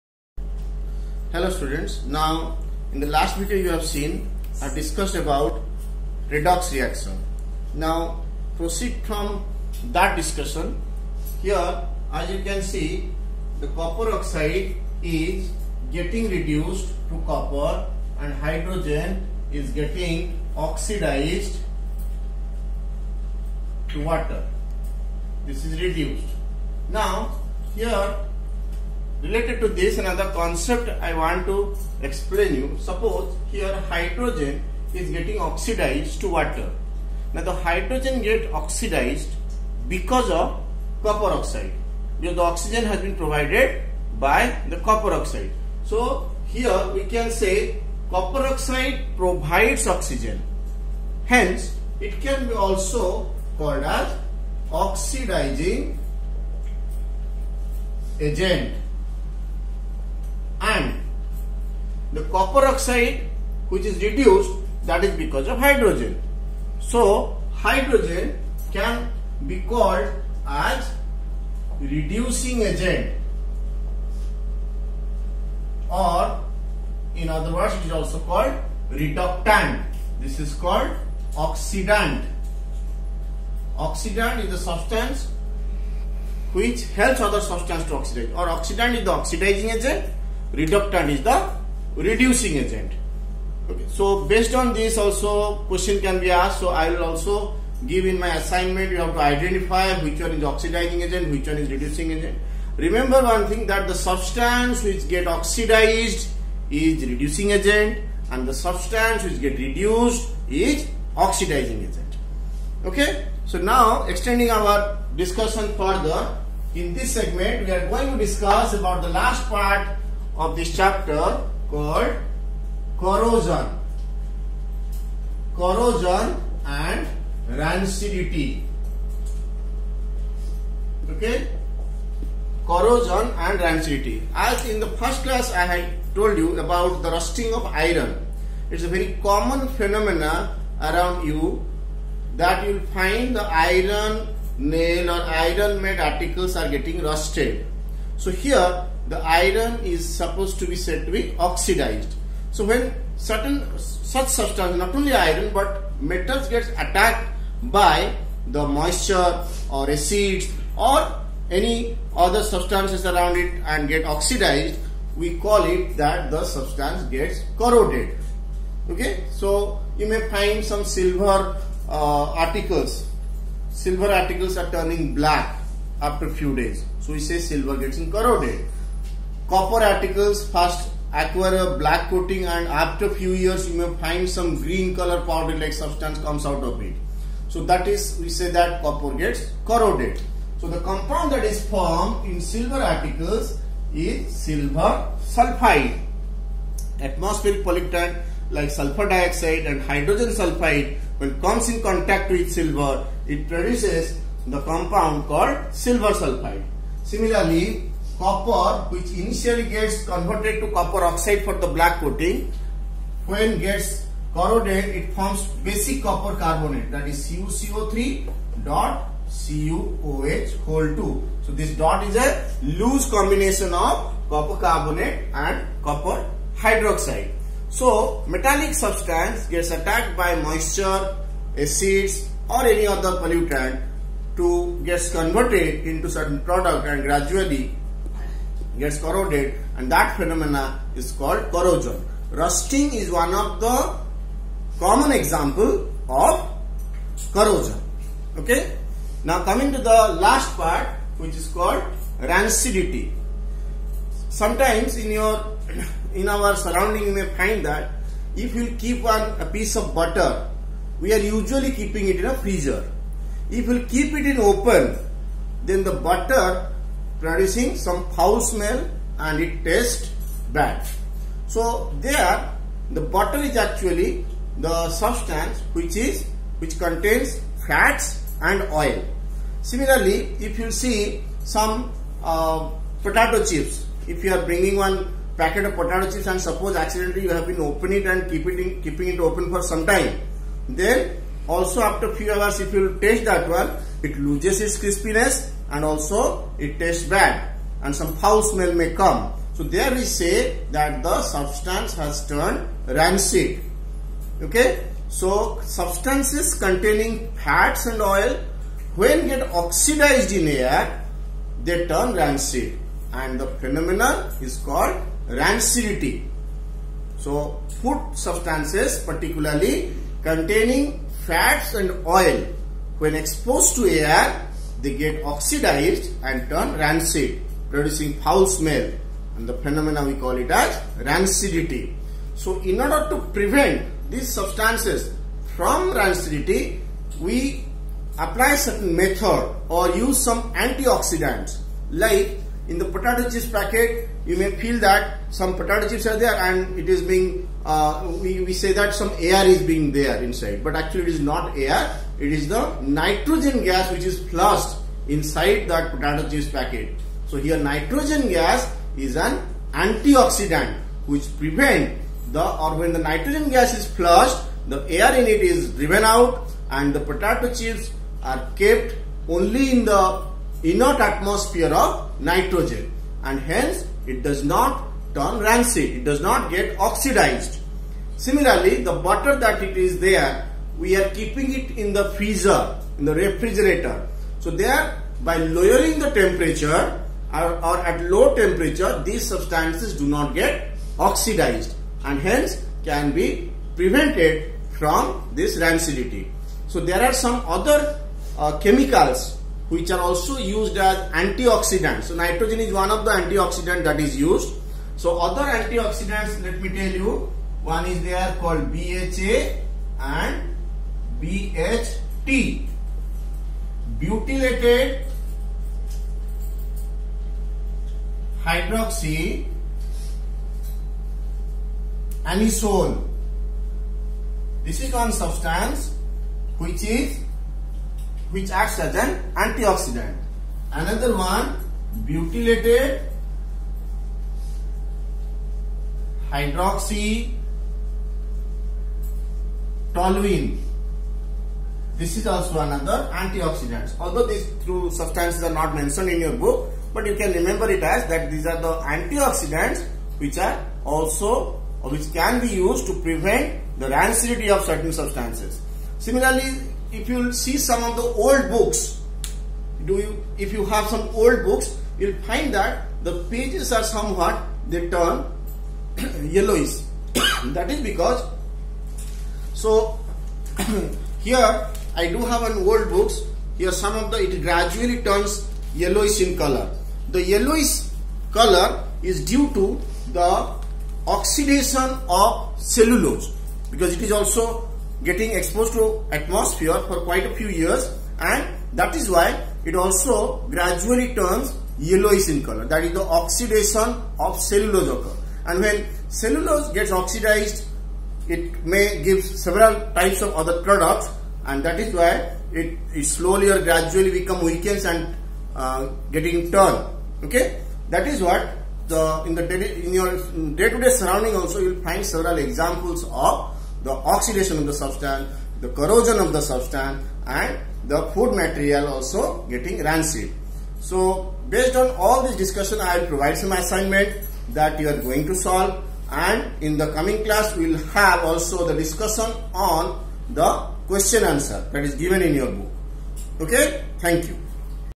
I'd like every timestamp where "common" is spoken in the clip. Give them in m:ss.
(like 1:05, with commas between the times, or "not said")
2:19, 4:04.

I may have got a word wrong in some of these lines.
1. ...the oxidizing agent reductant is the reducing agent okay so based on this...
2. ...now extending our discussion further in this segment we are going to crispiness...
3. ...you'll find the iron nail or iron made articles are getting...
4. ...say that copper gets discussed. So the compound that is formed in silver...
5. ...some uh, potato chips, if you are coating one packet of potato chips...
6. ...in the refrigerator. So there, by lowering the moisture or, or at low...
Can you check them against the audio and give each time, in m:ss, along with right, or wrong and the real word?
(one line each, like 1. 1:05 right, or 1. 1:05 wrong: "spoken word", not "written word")
1. 1:29 right
2. 1:53 wrong: "discuss", not "crispiness"
3. 2:22 right
4. 3:08 wrong: "corroded", not "discussed"
5. 4:41 wrong: "bringing", not "coating"
6. 6:22 wrong: "temperature", not "moisture".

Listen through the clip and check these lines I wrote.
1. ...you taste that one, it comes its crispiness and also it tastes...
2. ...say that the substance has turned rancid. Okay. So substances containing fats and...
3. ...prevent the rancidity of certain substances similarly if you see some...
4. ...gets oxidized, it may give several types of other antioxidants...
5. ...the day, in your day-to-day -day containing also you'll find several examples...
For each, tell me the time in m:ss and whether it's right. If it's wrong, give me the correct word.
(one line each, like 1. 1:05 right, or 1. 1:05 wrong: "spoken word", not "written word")
1. 4:52 wrong: "loses", not "comes"
2. 5:00 right
3. 7:33 right
4. 8:16 wrong: "products", not "antioxidants"
5. 8:29 wrong: "surrounding", not "containing".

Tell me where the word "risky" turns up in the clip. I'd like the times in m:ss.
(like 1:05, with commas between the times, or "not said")
not said.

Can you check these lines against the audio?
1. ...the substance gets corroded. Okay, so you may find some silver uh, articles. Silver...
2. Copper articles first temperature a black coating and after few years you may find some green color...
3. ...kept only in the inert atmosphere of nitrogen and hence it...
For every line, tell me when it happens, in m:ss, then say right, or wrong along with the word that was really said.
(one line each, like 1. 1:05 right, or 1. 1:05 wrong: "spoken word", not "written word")
1. 2:46 right
2. 2:59 wrong: "acquire", not "temperature"
3. 6:08 right.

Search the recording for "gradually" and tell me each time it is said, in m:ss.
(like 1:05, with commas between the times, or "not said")
3:57, 7:54, 8:10, 8:23.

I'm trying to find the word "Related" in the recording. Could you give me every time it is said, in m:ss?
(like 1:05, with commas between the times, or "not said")
0:29.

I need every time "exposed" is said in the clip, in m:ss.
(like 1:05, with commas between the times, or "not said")
5:23, 8:05.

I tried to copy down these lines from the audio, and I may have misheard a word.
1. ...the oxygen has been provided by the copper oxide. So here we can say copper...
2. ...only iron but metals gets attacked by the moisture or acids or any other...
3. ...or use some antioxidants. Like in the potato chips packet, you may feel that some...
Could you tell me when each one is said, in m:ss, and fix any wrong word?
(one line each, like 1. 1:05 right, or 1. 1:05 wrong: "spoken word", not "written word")
1. 0:42 right
2. 2:34 right
3. 5:39 right.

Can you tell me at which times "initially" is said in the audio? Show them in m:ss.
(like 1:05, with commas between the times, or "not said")
3:29.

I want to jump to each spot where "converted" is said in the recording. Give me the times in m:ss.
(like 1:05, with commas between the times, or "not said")
3:30, 3:55.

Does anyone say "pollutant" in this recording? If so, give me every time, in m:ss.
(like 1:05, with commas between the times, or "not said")
3:17, 3:53.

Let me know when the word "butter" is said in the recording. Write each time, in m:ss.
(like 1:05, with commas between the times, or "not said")
4:19, 4:25, 4:33, 6:18.